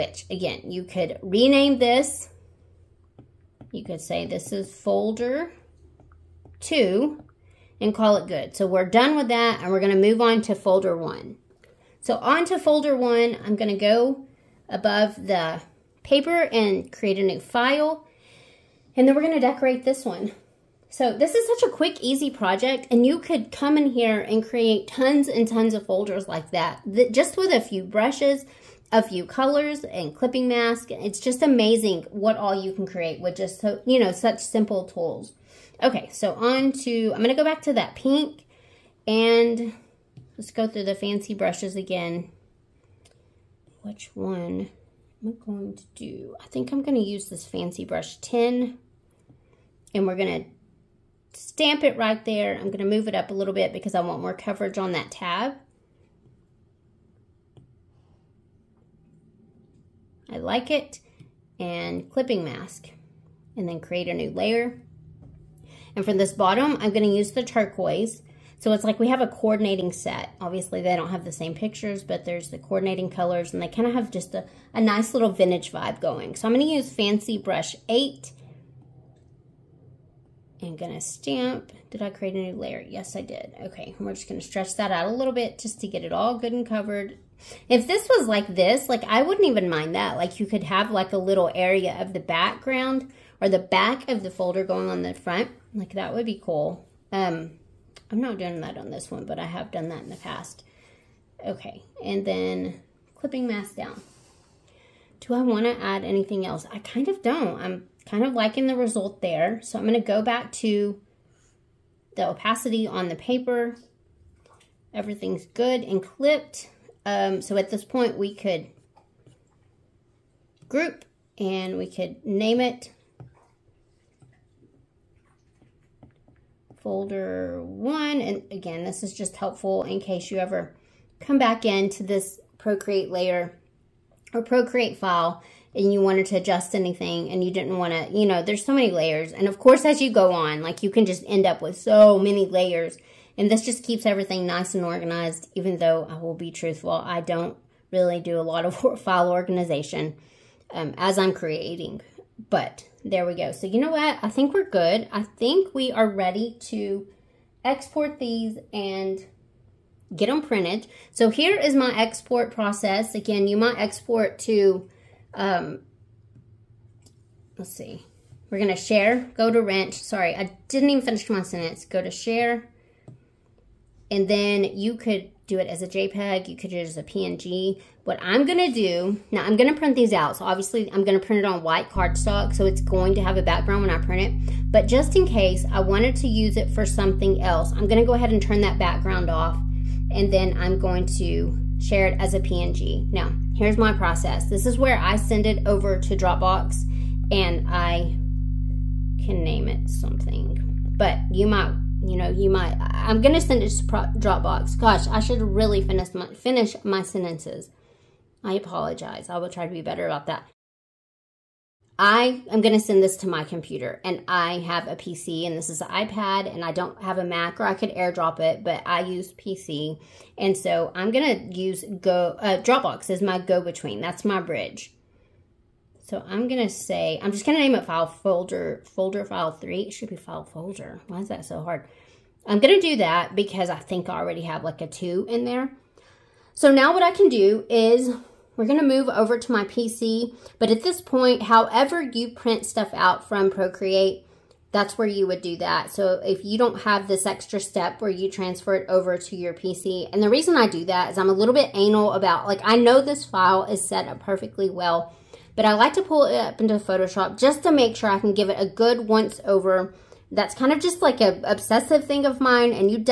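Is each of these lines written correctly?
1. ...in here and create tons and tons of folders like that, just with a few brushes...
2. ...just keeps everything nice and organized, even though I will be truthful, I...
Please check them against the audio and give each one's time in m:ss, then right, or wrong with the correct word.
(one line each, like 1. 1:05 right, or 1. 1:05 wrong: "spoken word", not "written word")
1. 0:23 right
2. 2:23 right.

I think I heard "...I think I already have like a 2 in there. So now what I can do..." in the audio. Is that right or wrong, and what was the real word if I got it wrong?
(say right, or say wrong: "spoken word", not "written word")
right.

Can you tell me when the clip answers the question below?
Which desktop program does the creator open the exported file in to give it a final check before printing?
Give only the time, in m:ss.
4:16.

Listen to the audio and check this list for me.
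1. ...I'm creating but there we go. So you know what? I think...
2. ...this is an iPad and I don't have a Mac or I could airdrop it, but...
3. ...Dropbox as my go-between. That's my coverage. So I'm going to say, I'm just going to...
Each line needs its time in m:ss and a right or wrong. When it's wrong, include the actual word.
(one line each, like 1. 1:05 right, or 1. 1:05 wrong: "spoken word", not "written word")
1. 2:31 right
2. 3:35 right
3. 3:42 wrong: "bridge", not "coverage".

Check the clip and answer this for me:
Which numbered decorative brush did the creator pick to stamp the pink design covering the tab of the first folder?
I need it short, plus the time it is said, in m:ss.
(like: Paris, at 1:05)
Fancy Brush 10, at 0:47.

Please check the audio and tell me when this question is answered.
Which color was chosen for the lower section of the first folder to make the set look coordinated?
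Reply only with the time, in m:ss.
1:07.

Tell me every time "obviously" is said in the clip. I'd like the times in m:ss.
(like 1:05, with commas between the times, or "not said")
1:10, 3:00.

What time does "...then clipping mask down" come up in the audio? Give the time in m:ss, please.
1:42.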